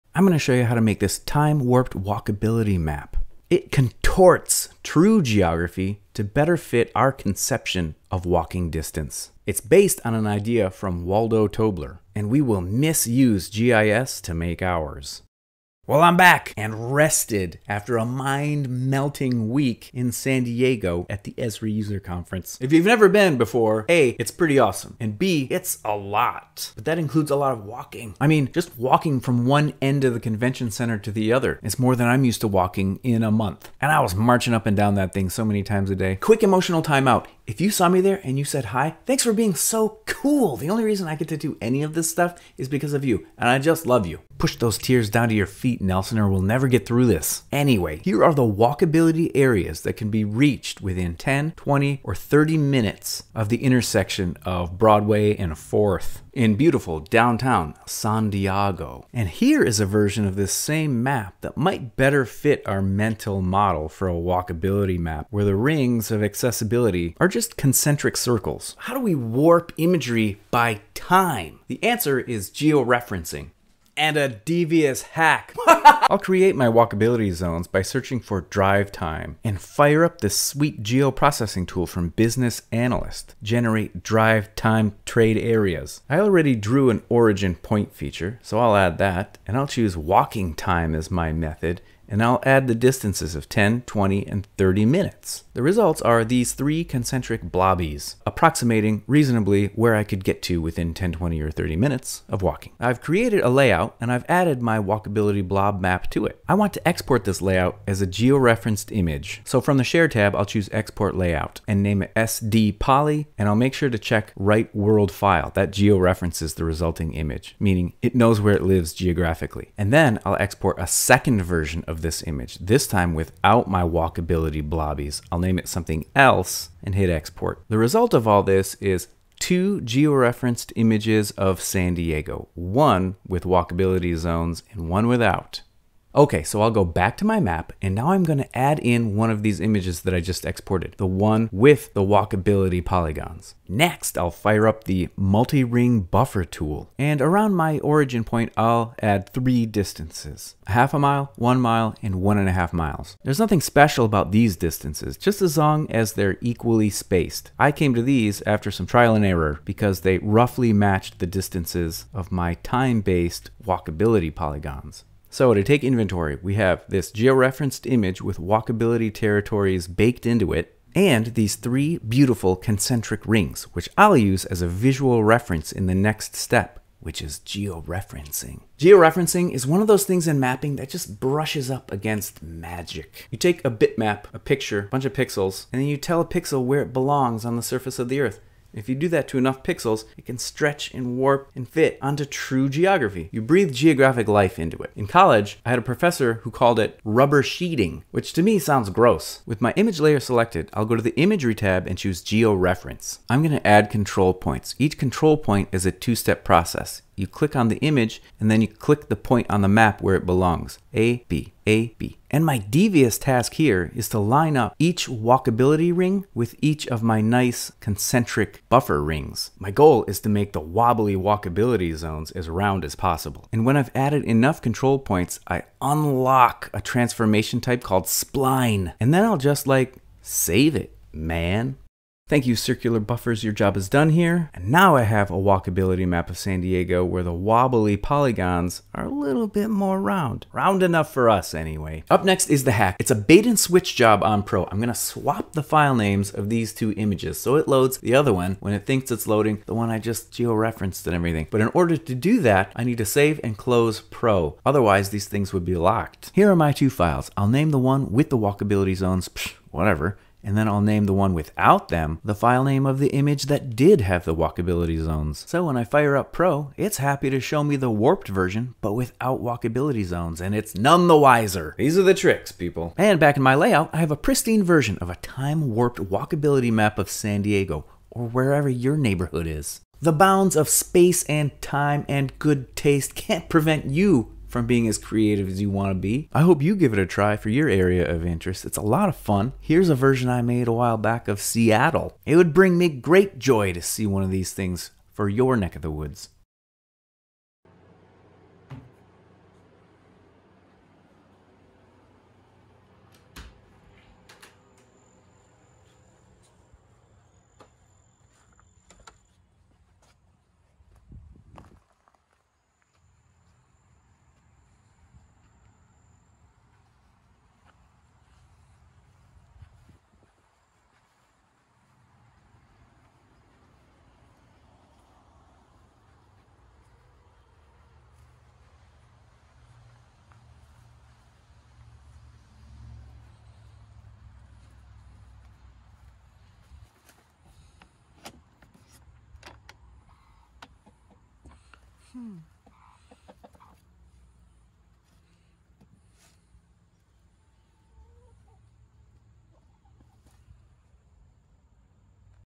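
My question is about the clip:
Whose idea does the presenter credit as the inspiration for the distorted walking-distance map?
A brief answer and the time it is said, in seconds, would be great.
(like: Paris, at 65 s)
Waldo Tobler, at 11 s.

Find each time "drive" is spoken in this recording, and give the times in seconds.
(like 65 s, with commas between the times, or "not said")
78 s, 84 s.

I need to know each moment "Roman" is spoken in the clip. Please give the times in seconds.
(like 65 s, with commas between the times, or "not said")
not said.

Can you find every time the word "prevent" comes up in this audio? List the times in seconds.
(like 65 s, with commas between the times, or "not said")
283 s.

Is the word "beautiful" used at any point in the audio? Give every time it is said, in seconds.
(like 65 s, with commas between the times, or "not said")
56 s, 171 s.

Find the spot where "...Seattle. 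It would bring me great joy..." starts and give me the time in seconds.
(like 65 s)
291 s.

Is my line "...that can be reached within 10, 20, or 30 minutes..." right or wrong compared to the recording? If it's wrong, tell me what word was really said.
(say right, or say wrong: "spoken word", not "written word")
right.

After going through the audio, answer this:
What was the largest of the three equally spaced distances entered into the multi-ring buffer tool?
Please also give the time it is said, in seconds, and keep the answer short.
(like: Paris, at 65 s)
1.5 miles, at 152 s.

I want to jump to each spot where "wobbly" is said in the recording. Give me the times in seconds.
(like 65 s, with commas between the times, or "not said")
220 s, 237 s.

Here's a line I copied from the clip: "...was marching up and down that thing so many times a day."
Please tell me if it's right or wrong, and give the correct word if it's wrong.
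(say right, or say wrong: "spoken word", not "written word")
right.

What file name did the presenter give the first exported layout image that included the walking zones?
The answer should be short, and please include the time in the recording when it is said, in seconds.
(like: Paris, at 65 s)
SD Poly, at 112 s.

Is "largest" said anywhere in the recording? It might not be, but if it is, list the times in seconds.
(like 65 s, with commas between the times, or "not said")
not said.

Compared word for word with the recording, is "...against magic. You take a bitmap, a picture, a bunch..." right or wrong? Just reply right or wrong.
right.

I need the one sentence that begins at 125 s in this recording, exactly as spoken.
I'll name it something else and hit export.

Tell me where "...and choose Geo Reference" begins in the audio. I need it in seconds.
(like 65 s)
201 s.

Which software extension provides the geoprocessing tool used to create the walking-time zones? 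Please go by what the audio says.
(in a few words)
Business Analyst.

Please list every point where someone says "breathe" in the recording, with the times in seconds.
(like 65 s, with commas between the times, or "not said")
193 s.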